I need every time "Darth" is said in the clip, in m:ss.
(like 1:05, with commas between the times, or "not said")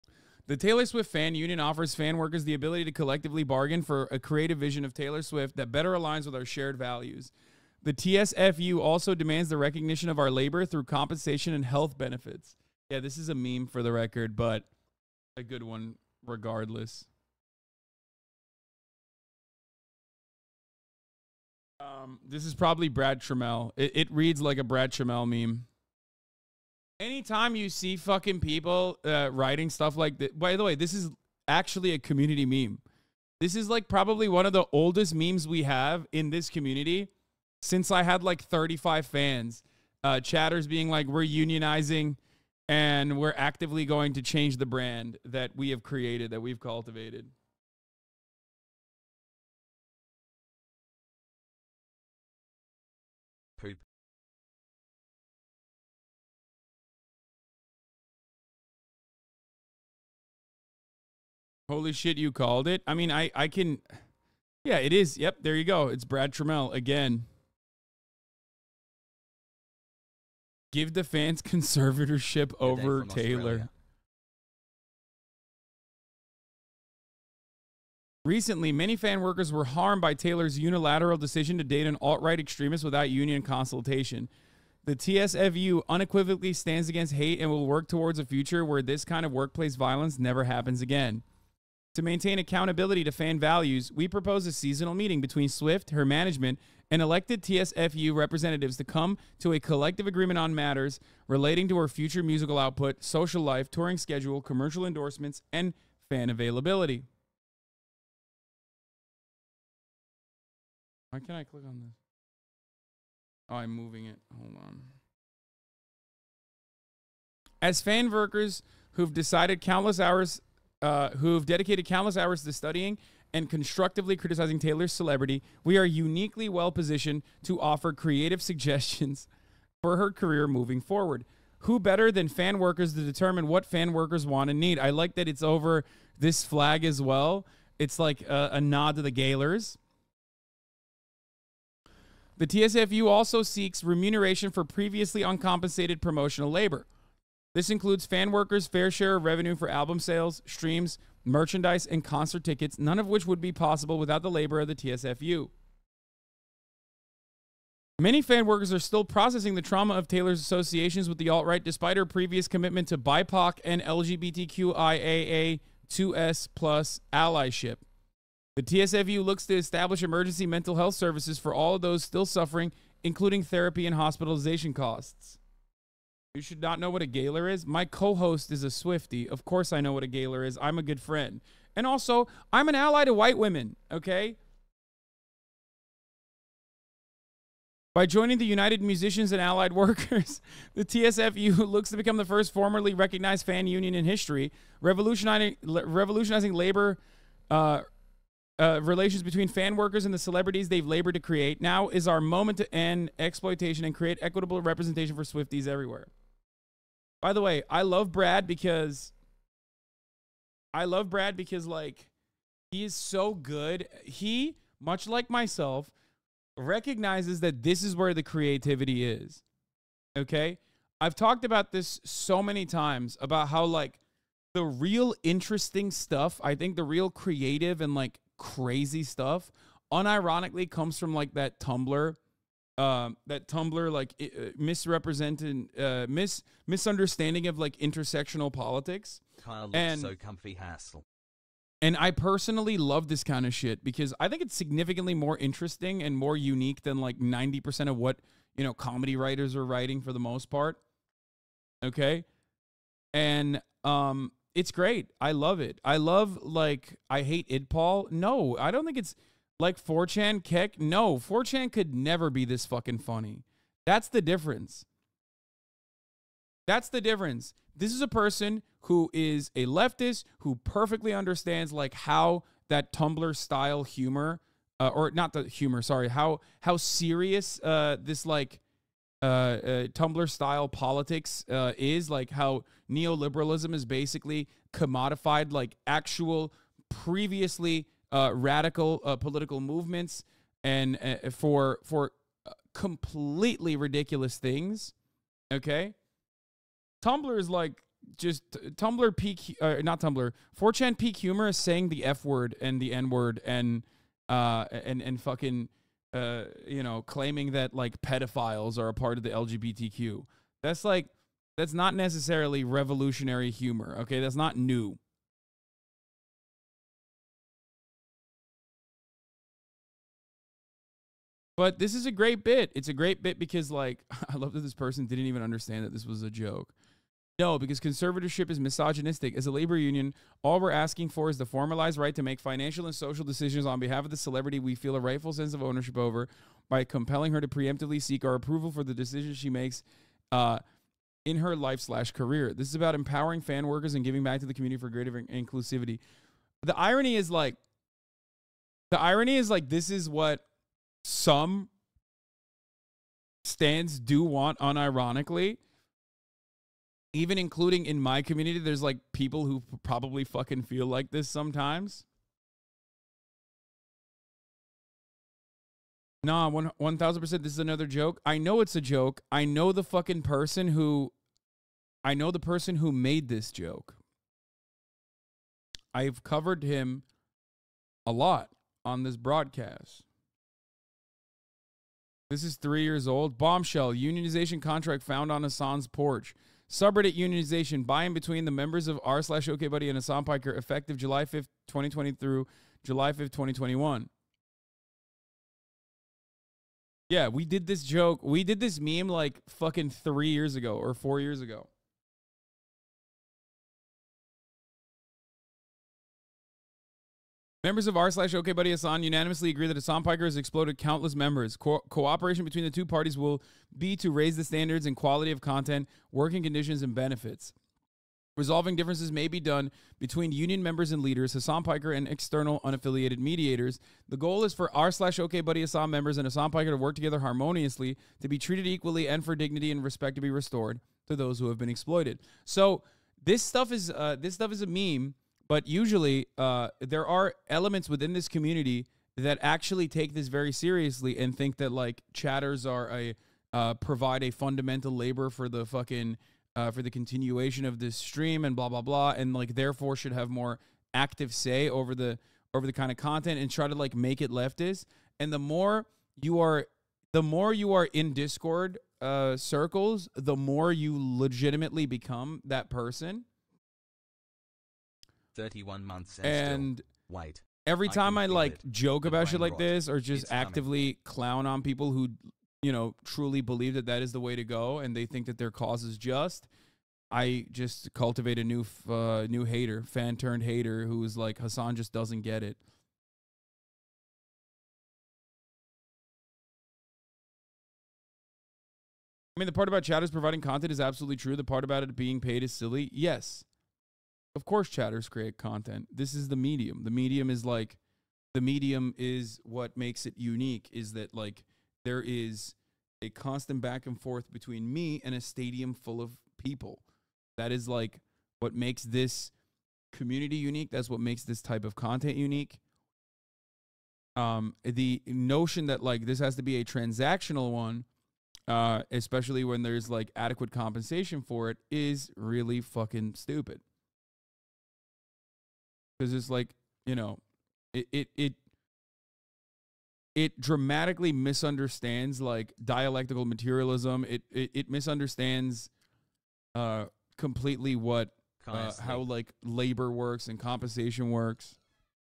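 not said.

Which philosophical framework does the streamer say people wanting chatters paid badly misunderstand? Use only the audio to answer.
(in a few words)
Dialectical materialism.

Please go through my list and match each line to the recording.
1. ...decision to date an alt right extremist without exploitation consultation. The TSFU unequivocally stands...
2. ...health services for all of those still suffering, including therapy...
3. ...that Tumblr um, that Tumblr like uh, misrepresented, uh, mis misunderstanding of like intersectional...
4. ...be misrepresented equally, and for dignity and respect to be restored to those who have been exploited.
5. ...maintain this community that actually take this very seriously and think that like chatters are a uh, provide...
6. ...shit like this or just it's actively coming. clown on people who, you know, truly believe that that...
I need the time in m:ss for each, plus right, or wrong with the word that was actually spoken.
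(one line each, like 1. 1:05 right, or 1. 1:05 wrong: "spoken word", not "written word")
1. 1:21 wrong: "union", not "exploitation"
2. 2:50 right
3. 3:51 right
4. 7:08 wrong: "treated", not "misrepresented"
5. 7:17 wrong: "within", not "maintain"
6. 7:49 right.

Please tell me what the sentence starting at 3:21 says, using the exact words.
Now is our moment to end exploitation and create equitable representation for Swifties everywhere.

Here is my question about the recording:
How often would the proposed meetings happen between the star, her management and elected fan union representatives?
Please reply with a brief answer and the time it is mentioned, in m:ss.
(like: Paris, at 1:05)
Seasonal, at 1:34.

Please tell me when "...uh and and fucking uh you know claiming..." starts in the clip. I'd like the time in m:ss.
5:04.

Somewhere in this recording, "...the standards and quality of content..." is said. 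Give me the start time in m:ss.
6:54.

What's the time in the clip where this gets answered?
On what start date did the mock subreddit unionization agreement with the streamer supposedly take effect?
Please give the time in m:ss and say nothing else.
6:30.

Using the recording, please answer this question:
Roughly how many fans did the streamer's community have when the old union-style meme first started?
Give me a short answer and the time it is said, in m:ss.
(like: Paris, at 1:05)
35, at 0:38.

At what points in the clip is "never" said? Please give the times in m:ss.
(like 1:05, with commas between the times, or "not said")
1:30, 4:21.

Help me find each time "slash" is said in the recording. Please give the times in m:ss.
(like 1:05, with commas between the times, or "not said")
5:41, 6:29, 6:48, 7:04.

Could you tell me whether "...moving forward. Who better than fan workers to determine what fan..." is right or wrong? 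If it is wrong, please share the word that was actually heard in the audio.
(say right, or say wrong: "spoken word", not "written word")
right.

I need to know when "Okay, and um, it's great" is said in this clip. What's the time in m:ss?
4:11.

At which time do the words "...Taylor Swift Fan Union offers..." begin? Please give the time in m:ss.
0:00.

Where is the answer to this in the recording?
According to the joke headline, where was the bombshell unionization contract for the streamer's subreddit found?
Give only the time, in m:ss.
6:25.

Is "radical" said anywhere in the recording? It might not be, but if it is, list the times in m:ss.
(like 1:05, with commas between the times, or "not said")
4:48.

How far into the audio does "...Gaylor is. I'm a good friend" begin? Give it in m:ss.
3:00.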